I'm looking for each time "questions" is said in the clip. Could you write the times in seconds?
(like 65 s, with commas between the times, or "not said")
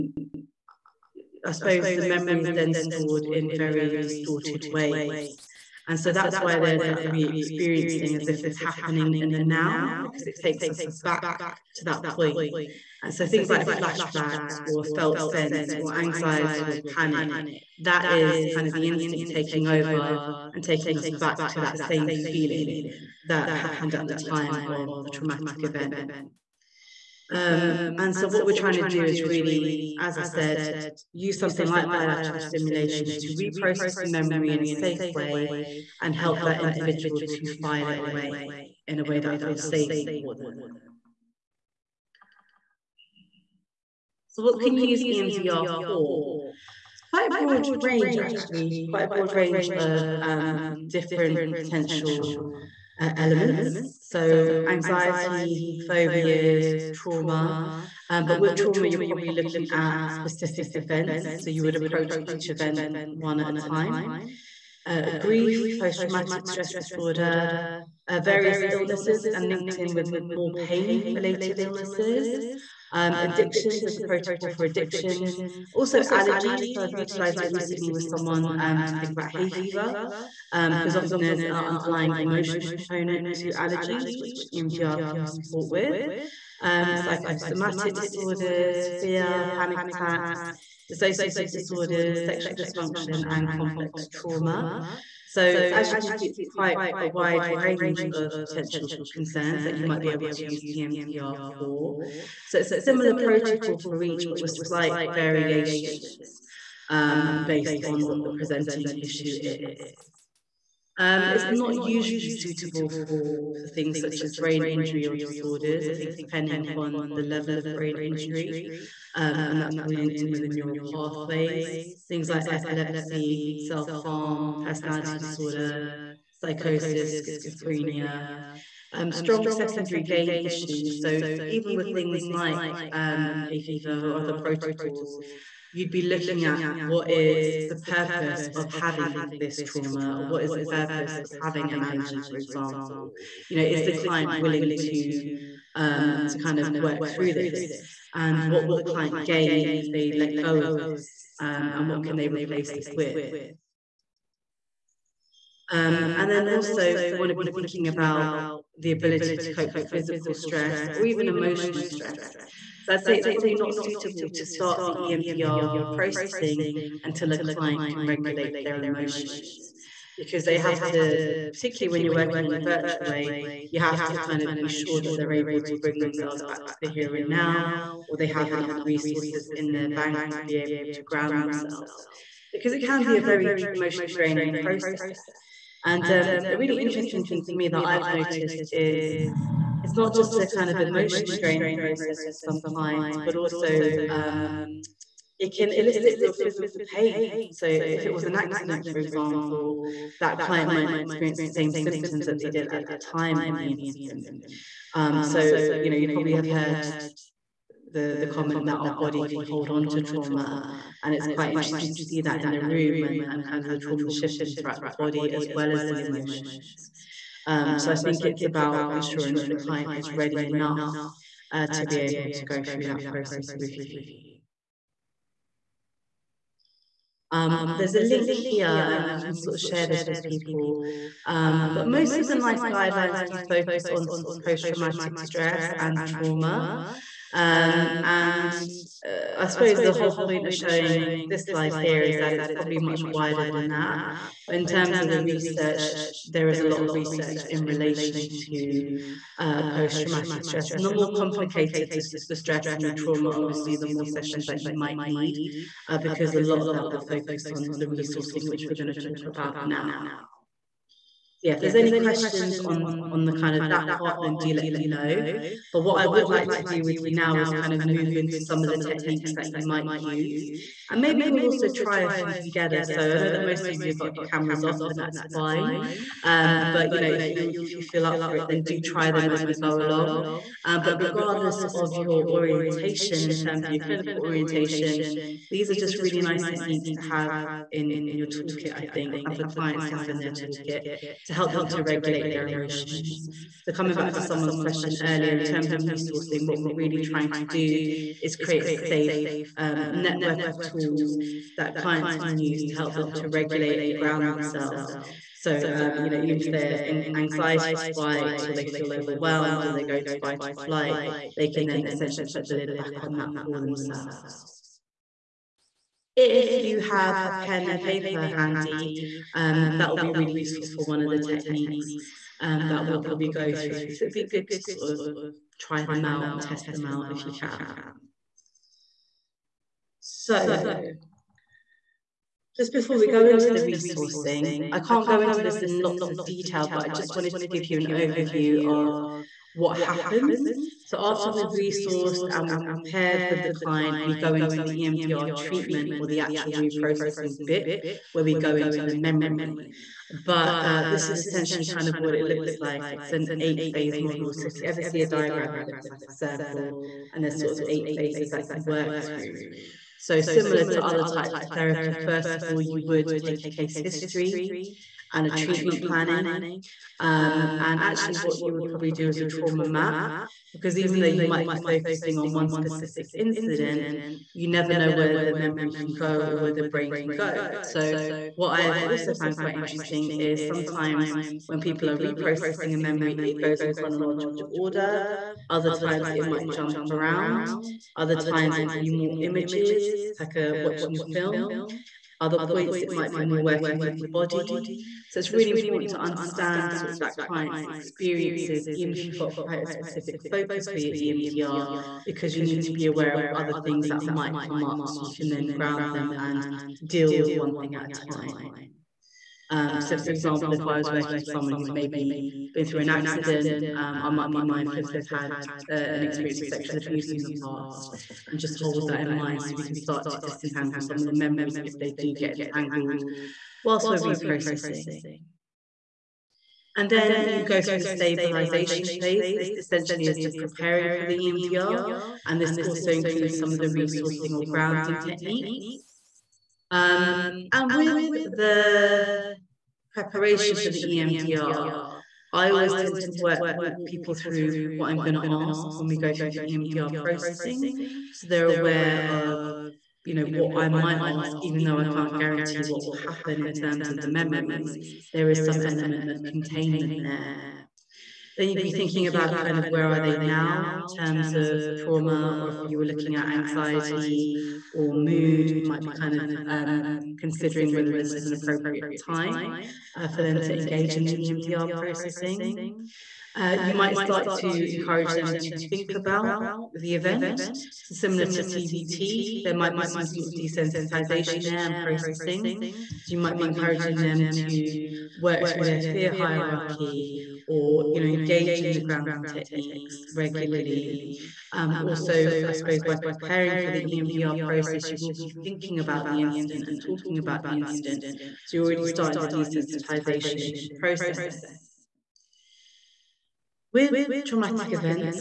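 261 s, 294 s.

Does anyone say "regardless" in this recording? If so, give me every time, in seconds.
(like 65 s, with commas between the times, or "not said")
280 s.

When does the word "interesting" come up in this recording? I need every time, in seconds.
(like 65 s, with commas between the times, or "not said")
186 s, 211 s, 379 s.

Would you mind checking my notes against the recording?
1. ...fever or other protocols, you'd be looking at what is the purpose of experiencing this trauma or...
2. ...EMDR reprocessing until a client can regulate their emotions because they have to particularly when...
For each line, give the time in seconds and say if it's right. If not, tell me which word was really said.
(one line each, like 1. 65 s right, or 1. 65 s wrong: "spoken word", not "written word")
1. 133 s wrong: "having", not "experiencing"
2. 165 s right.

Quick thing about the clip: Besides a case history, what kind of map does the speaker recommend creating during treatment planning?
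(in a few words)
trauma map.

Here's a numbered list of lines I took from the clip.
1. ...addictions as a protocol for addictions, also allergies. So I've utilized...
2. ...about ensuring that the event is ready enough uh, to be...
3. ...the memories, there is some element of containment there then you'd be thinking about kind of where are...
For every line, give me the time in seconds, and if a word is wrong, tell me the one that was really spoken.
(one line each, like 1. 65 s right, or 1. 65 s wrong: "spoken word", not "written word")
1. 73 s right
2. 218 s wrong: "client", not "event"
3. 454 s right.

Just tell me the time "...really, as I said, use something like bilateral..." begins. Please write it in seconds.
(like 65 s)
29 s.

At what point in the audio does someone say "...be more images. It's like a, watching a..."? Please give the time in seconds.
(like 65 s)
388 s.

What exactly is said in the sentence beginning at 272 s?
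So I know that most of you have got your cameras off, and that's fine.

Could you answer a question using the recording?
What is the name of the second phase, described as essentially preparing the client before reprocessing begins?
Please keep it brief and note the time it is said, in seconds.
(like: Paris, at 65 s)
stabilization phase, at 427 s.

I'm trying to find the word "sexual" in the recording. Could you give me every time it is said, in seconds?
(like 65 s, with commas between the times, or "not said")
92 s, 416 s.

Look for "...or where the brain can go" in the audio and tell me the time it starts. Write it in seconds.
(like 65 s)
376 s.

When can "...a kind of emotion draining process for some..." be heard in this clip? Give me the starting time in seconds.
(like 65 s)
190 s.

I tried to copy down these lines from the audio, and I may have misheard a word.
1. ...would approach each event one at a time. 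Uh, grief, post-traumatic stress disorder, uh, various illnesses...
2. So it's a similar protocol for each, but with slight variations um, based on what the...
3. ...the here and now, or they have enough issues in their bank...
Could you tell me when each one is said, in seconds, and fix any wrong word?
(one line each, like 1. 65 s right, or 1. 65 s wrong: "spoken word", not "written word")
1. 61 s right
2. 102 s right
3. 176 s wrong: "resources", not "issues".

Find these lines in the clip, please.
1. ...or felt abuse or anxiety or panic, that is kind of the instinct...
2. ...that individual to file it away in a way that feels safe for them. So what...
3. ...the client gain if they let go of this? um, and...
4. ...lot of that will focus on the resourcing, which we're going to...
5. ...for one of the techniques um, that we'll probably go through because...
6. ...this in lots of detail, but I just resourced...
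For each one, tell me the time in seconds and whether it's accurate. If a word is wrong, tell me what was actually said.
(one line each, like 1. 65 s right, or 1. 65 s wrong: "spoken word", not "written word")
1. 14 s wrong: "sense", not "abuse"
2. 36 s right
3. 148 s right
4. 256 s right
5. 320 s right
6. 335 s wrong: "wanted", not "resourced".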